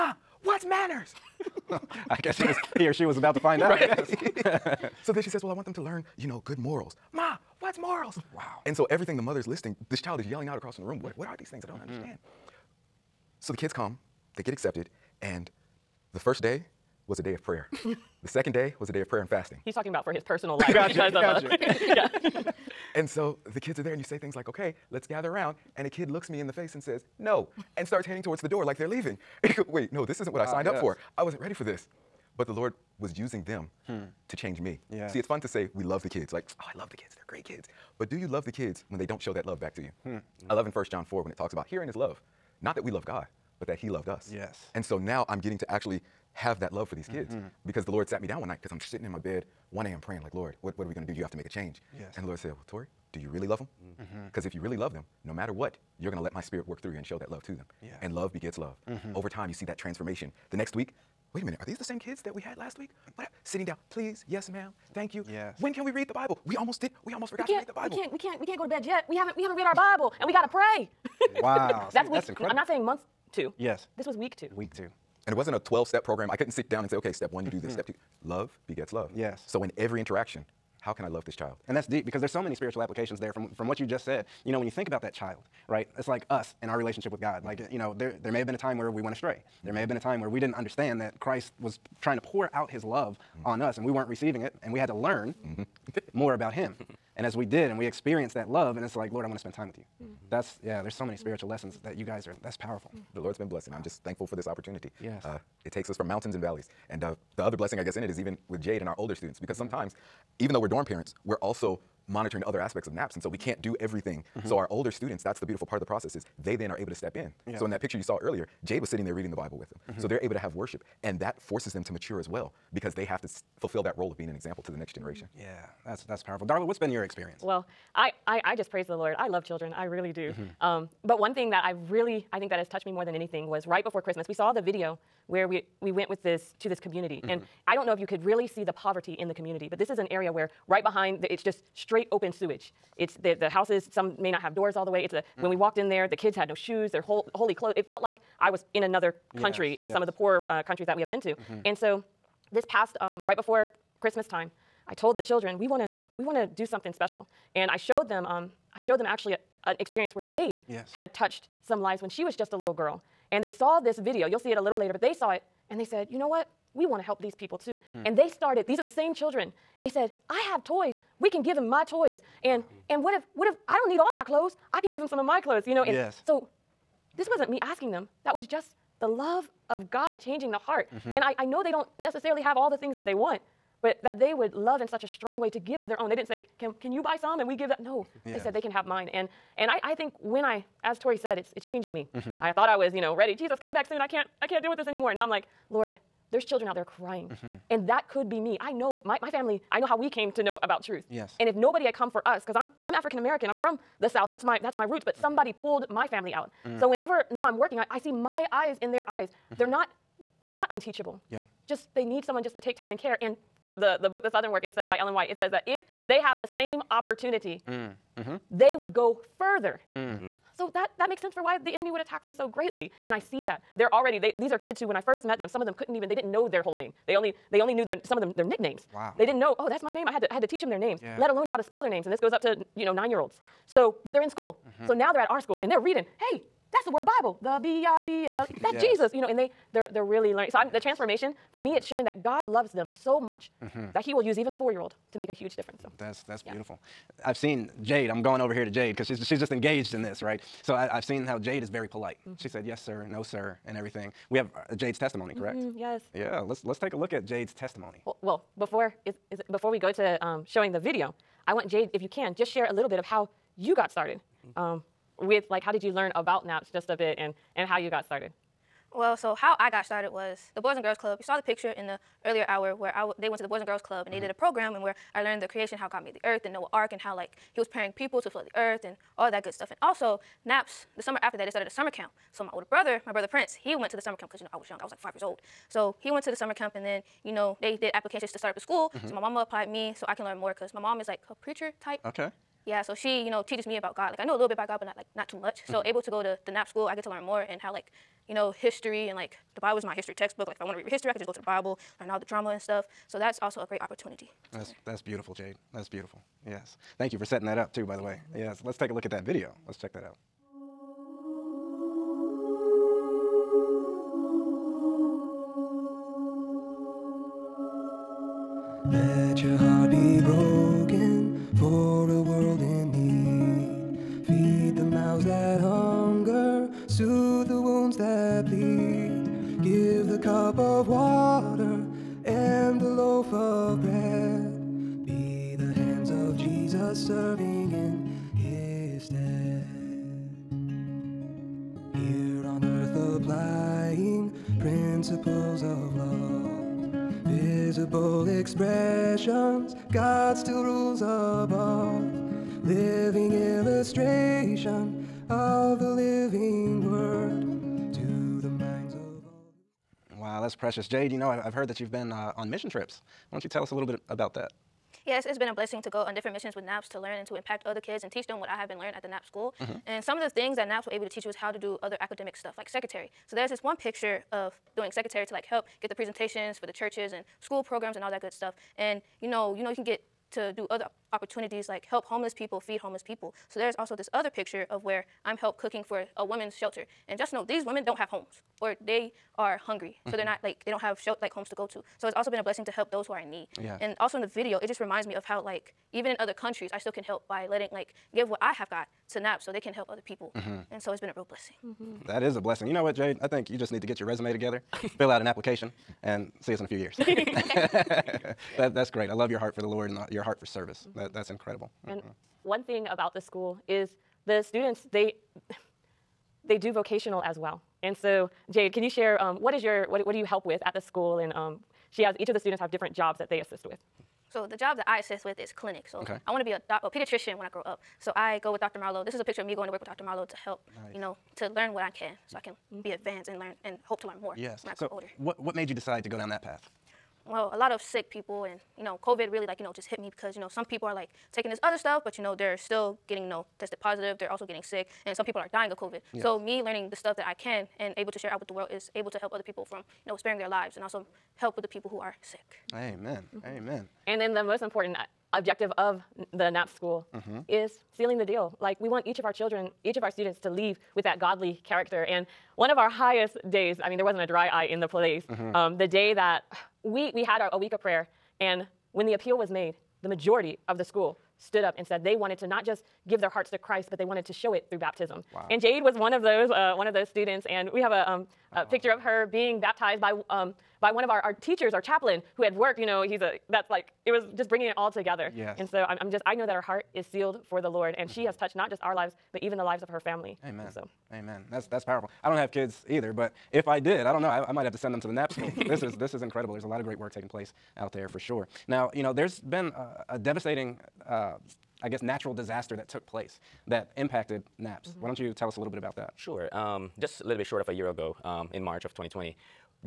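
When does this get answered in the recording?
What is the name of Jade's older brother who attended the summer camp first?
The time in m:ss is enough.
4:43.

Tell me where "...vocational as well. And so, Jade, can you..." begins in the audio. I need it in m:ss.
6:56.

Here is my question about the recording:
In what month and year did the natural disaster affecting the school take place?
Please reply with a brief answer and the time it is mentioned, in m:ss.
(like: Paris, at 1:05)
March 2020, at 8:28.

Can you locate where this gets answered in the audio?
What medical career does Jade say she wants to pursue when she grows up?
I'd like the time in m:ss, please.
7:06.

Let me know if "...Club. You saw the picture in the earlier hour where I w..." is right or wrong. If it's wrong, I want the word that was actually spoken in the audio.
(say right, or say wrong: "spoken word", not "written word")
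right.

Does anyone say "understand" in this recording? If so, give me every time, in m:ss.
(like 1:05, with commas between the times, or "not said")
0:11, 1:30.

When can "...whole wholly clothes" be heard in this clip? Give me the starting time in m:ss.
2:27.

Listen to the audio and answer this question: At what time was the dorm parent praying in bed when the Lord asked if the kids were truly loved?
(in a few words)
1 a.m.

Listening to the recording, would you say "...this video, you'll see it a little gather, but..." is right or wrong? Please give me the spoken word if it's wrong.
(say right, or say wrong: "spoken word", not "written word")
wrong: "later", not "gather".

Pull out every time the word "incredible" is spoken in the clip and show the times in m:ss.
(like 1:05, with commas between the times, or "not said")
1:12, 6:51, 8:16.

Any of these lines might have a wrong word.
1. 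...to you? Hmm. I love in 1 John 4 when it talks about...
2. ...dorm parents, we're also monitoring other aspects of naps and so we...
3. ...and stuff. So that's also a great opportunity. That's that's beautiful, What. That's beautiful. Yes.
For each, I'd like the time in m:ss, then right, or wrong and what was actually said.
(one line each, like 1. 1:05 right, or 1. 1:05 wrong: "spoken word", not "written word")
1. 0:39 right
2. 1:50 right
3. 5:02 wrong: "Jade", not "What".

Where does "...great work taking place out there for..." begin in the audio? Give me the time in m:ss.
8:16.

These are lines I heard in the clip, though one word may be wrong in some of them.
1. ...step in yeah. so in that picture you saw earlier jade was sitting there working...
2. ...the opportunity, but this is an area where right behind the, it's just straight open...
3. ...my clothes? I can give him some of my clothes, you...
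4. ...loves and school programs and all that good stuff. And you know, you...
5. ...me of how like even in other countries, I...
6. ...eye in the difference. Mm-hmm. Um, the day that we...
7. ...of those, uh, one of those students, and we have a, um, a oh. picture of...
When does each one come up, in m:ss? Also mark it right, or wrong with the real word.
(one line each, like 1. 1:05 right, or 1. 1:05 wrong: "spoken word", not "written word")
1. 1:56 wrong: "reading", not "working"
2. 2:19 wrong: "community", not "opportunity"
3. 2:54 right
4. 6:16 wrong: "churches", not "loves"
5. 6:35 right
6. 7:44 wrong: "place", not "difference"
7. 7:56 right.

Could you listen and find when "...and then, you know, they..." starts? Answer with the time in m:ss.
4:46.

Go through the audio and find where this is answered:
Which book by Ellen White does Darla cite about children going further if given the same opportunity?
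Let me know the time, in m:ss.
3:34.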